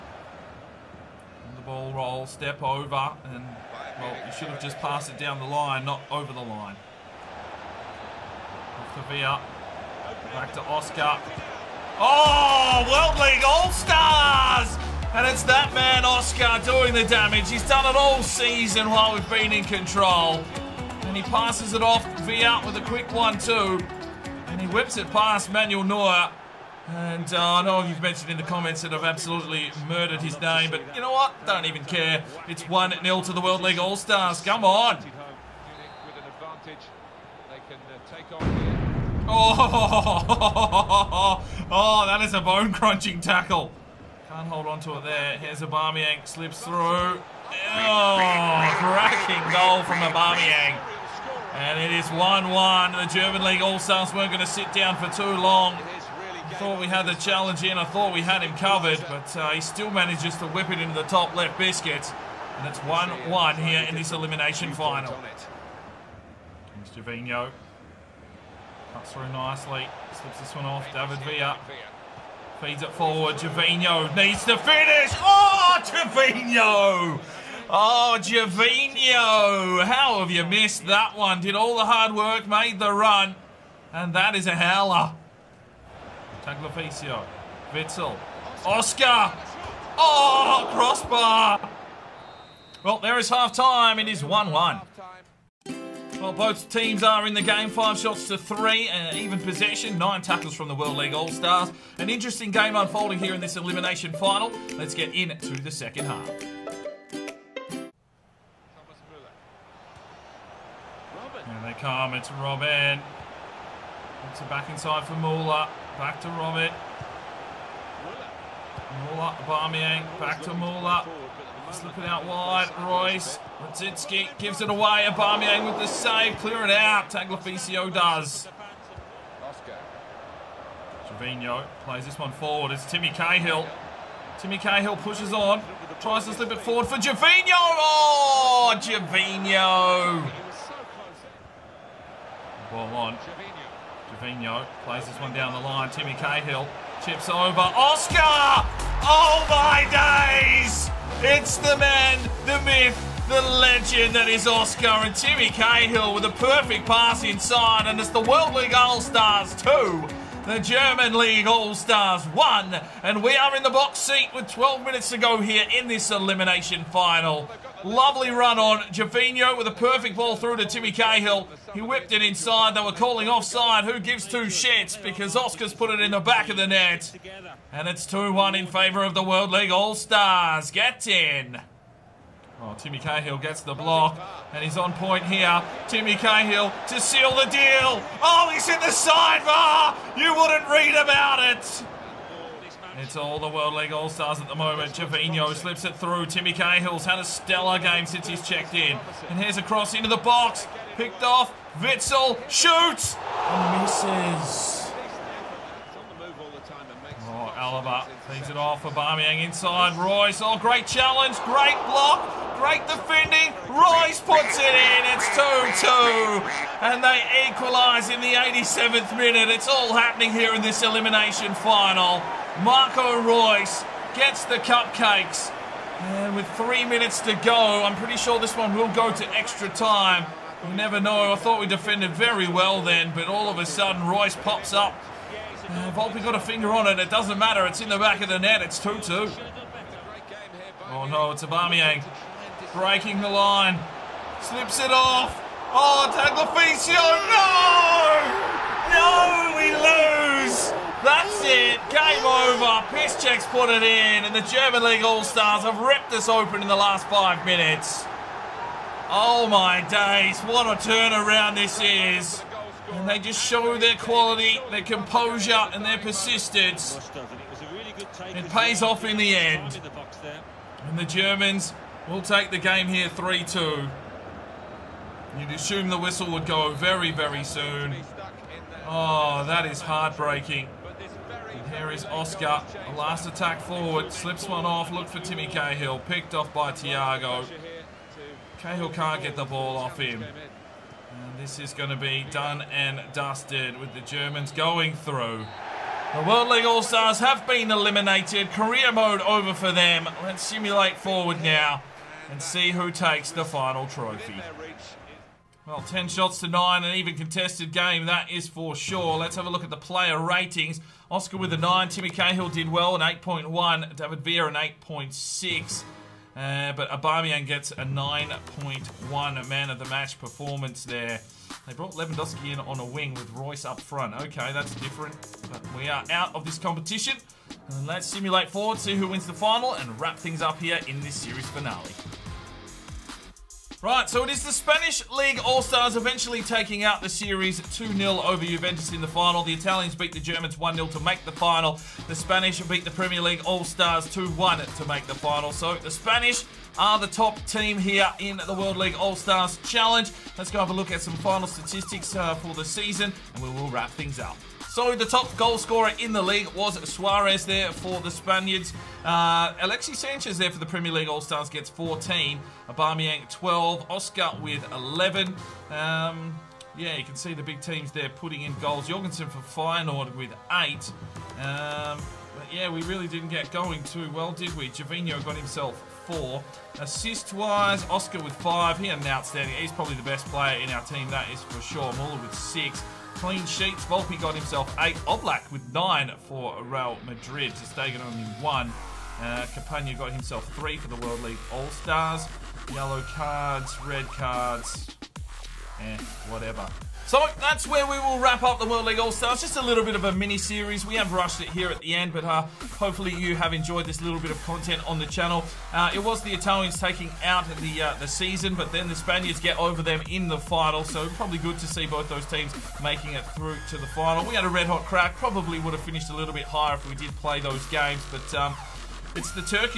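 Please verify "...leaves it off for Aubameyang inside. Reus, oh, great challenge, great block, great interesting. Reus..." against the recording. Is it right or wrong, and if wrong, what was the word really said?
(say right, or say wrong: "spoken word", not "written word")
wrong: "defending", not "interesting".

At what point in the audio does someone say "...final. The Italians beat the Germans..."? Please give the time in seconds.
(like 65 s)
339 s.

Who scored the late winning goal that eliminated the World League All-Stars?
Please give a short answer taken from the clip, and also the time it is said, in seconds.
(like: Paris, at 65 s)
Piszczek, at 252 s.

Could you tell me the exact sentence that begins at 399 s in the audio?
Just a little bit of a mini series.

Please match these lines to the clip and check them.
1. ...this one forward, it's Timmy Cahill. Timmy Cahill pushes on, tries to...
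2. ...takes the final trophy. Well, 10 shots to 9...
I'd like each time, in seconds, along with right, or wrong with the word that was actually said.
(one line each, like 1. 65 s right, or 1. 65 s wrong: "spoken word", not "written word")
1. 132 s right
2. 302 s right.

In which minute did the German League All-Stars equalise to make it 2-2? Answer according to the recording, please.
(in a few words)
87th.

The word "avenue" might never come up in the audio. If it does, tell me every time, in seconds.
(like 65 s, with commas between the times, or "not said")
not said.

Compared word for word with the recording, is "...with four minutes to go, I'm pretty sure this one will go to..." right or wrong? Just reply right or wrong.
wrong.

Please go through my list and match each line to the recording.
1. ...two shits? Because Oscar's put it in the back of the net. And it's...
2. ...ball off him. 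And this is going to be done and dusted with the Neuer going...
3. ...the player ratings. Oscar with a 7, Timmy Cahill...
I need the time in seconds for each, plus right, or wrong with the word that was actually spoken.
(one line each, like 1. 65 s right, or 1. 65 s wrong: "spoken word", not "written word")
1. 174 s right
2. 289 s wrong: "Germans", not "Neuer"
3. 309 s wrong: "9", not "7".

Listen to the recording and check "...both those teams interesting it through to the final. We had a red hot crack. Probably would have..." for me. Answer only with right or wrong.
wrong.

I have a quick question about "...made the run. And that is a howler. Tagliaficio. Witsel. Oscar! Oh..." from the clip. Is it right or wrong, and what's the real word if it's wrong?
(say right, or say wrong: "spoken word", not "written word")
right.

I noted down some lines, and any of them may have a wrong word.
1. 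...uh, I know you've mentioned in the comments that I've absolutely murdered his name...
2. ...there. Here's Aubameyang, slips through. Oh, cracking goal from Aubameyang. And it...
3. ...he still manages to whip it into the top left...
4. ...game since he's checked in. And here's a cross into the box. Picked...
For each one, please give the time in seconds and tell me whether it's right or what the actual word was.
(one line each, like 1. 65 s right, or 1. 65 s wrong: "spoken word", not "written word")
1. 27 s right
2. 45 s right
3. 59 s right
4. 197 s right.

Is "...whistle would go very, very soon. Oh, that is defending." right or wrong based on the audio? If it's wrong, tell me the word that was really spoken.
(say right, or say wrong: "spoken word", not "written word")
wrong: "heartbreaking", not "defending".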